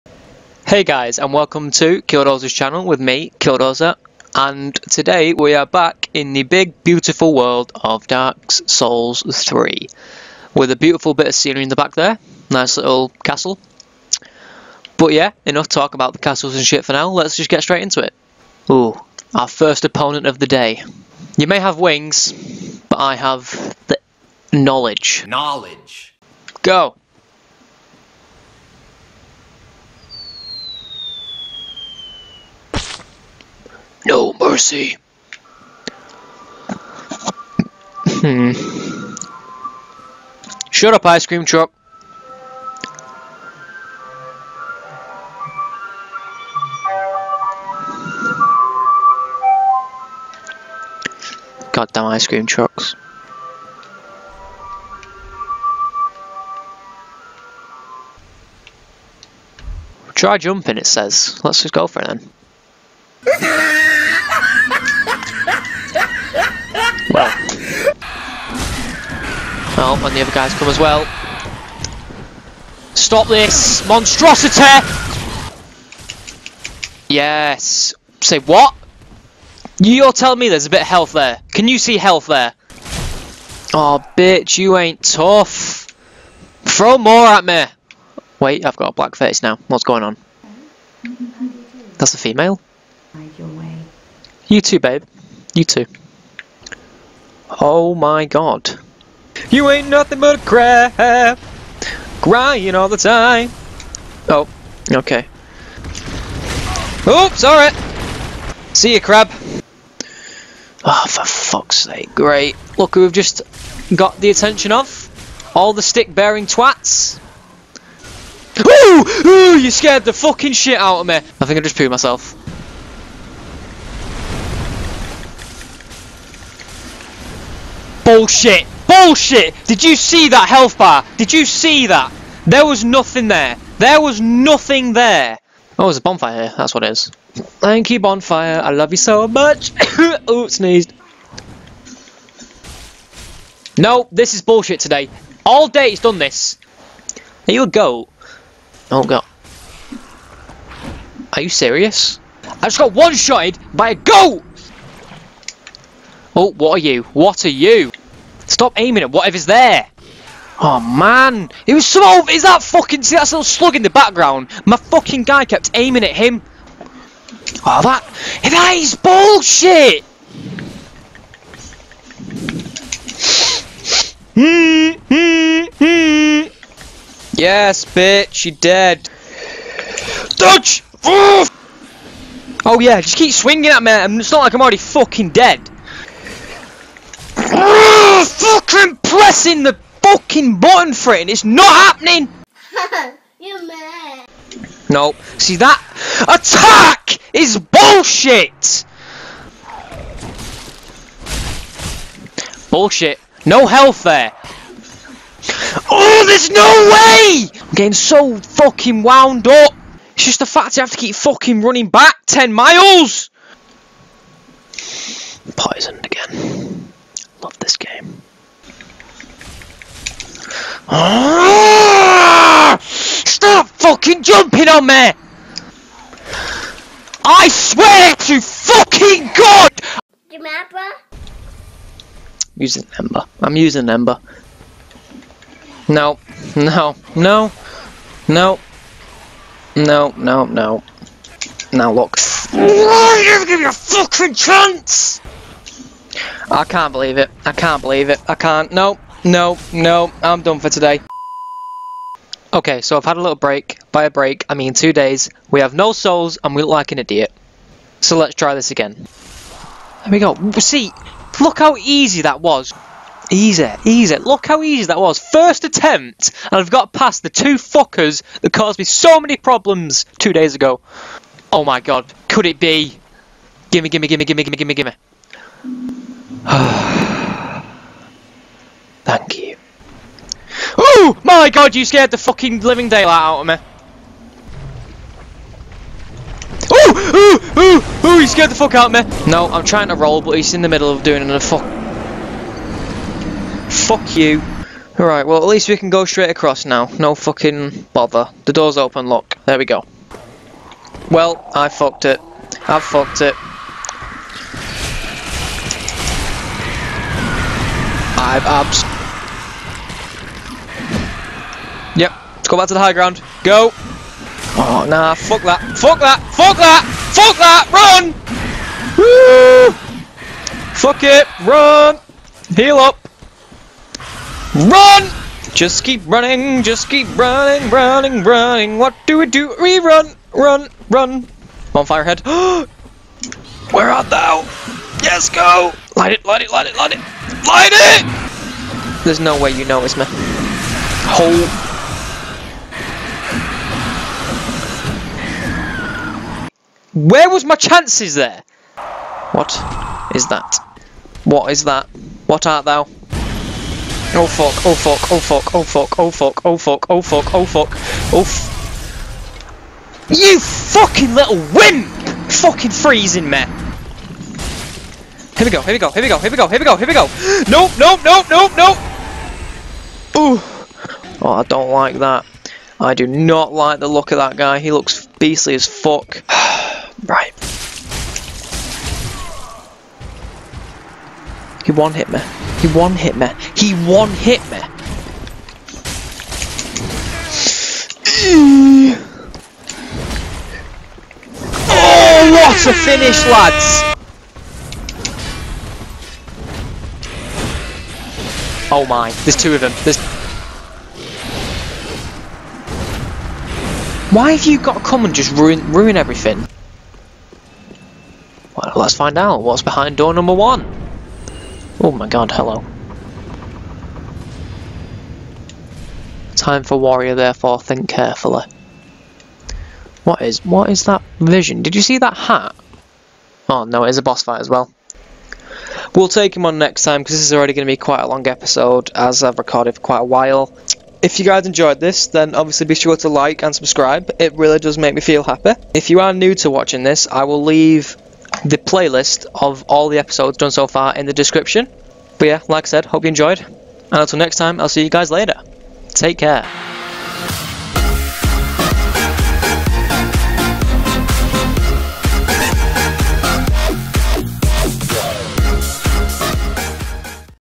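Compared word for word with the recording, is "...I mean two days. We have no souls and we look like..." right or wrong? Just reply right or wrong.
right.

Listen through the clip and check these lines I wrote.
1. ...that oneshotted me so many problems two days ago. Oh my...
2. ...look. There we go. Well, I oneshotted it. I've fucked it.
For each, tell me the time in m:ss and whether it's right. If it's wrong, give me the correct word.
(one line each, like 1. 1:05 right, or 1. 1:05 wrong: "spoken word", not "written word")
1. 4:28 wrong: "caused", not "oneshotted"
2. 4:59 wrong: "fucked", not "oneshotted".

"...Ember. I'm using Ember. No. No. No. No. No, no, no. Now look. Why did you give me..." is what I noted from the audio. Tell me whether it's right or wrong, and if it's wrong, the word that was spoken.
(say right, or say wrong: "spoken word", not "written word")
right.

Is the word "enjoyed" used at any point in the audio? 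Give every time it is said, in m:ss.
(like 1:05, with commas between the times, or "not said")
7:11, 7:23.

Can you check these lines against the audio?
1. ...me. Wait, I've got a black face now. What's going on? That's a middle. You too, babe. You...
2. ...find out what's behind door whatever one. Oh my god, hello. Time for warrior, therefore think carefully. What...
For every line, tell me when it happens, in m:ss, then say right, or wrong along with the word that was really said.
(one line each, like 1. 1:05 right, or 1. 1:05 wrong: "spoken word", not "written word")
1. 1:27 wrong: "female", not "middle"
2. 6:48 wrong: "number", not "whatever".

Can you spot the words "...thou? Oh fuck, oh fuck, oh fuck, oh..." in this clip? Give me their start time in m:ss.
5:52.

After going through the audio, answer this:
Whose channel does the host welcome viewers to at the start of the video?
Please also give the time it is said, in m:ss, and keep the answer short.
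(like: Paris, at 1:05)
Killdozer's channel, at 0:02.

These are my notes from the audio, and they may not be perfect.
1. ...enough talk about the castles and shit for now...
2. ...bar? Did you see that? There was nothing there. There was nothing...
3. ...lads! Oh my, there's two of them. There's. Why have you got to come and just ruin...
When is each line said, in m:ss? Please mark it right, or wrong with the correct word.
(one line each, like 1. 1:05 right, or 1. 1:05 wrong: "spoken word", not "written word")
1. 0:15 right
2. 2:10 right
3. 6:33 right.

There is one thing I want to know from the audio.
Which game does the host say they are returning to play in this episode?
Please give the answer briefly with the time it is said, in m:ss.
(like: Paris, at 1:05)
Dark Souls 3, at 0:08.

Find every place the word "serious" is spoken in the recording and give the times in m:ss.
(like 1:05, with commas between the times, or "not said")
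2:31.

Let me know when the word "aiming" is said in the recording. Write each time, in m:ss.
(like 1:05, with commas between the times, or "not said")
2:38, 2:45.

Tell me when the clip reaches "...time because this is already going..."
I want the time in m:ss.
7:06.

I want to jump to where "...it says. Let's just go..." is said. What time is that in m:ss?
1:00.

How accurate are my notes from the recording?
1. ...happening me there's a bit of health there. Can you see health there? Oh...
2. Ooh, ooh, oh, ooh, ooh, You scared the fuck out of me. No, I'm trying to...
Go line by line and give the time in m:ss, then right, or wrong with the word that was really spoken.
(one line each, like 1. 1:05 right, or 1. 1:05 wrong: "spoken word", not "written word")
1. 1:20 wrong: "telling", not "happening"
2. 4:46 right.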